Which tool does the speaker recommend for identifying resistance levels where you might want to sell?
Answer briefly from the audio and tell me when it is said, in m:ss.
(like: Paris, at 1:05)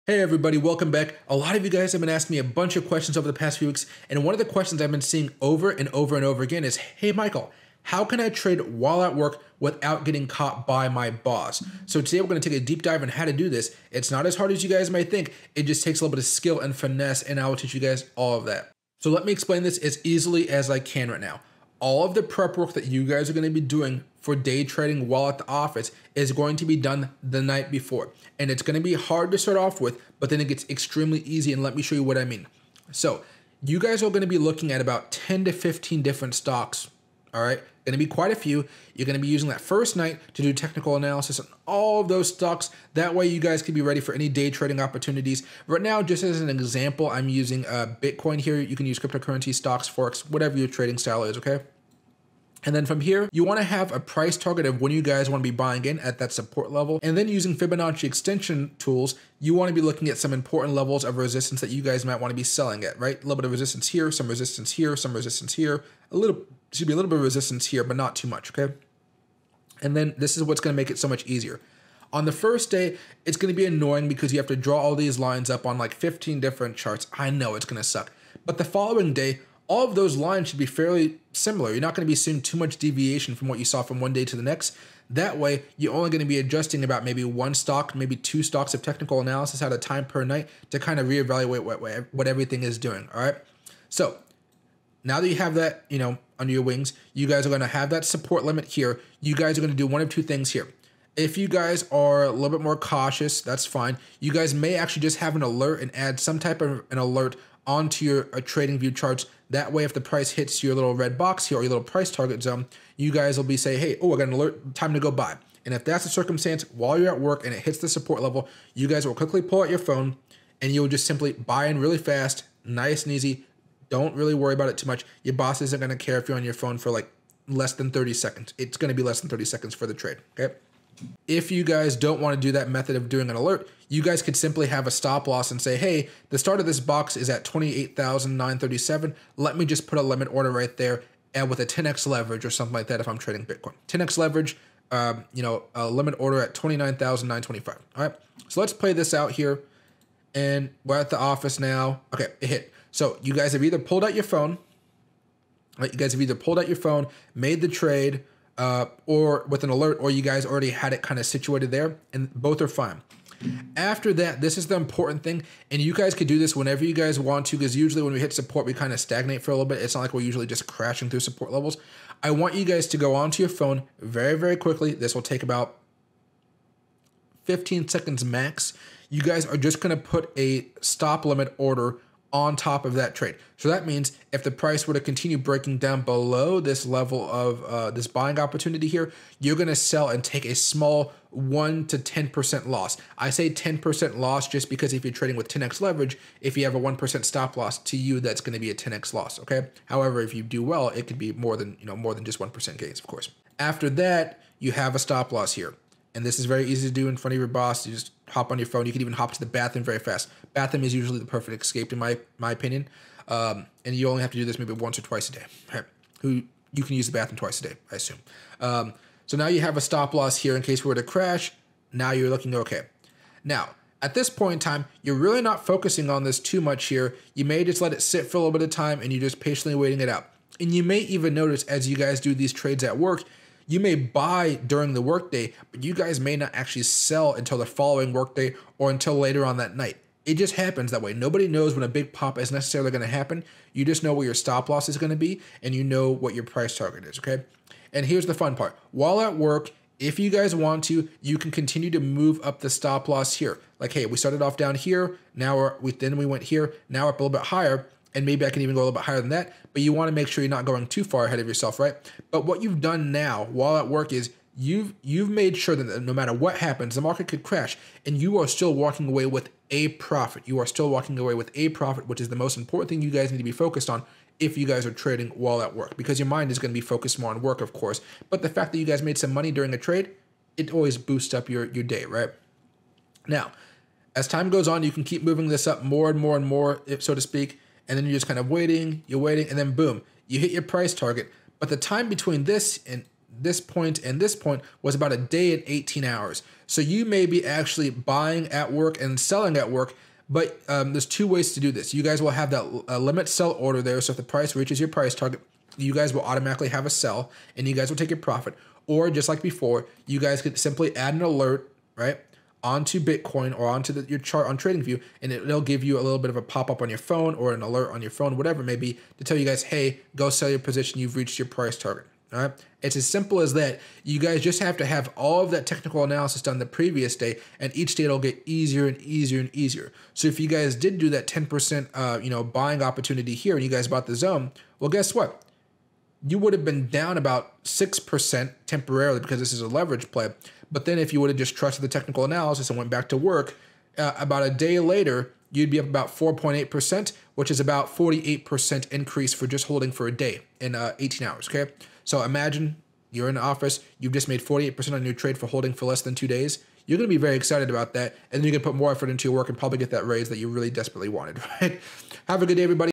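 Fibonacci extension tools, at 0:57.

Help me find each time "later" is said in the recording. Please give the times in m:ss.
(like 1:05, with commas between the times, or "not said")
3:59, 5:44.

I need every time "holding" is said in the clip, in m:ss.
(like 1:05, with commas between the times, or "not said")
5:49, 5:55.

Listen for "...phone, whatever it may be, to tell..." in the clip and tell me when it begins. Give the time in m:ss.
5:18.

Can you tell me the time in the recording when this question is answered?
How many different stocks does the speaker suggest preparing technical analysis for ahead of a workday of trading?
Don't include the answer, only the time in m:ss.
0:35.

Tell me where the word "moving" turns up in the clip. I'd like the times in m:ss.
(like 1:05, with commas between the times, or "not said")
4:45.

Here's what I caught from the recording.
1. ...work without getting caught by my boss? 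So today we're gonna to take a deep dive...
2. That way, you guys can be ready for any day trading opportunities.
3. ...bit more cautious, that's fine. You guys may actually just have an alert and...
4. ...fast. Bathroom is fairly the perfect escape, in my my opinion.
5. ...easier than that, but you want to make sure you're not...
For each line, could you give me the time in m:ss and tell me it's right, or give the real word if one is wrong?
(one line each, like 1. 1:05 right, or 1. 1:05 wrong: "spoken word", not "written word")
1. 0:09 right
2. 0:42 right
3. 1:42 right
4. 3:29 wrong: "usually", not "fairly"
5. 4:19 wrong: "higher", not "easier".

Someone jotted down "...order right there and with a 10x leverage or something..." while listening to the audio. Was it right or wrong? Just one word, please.
right.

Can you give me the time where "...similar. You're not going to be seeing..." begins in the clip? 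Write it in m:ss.
1:21.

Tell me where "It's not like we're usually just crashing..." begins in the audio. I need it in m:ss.
2:49.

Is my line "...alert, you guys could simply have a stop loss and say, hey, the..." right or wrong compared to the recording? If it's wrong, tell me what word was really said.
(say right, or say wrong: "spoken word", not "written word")
right.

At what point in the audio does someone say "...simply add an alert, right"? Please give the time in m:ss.
5:10.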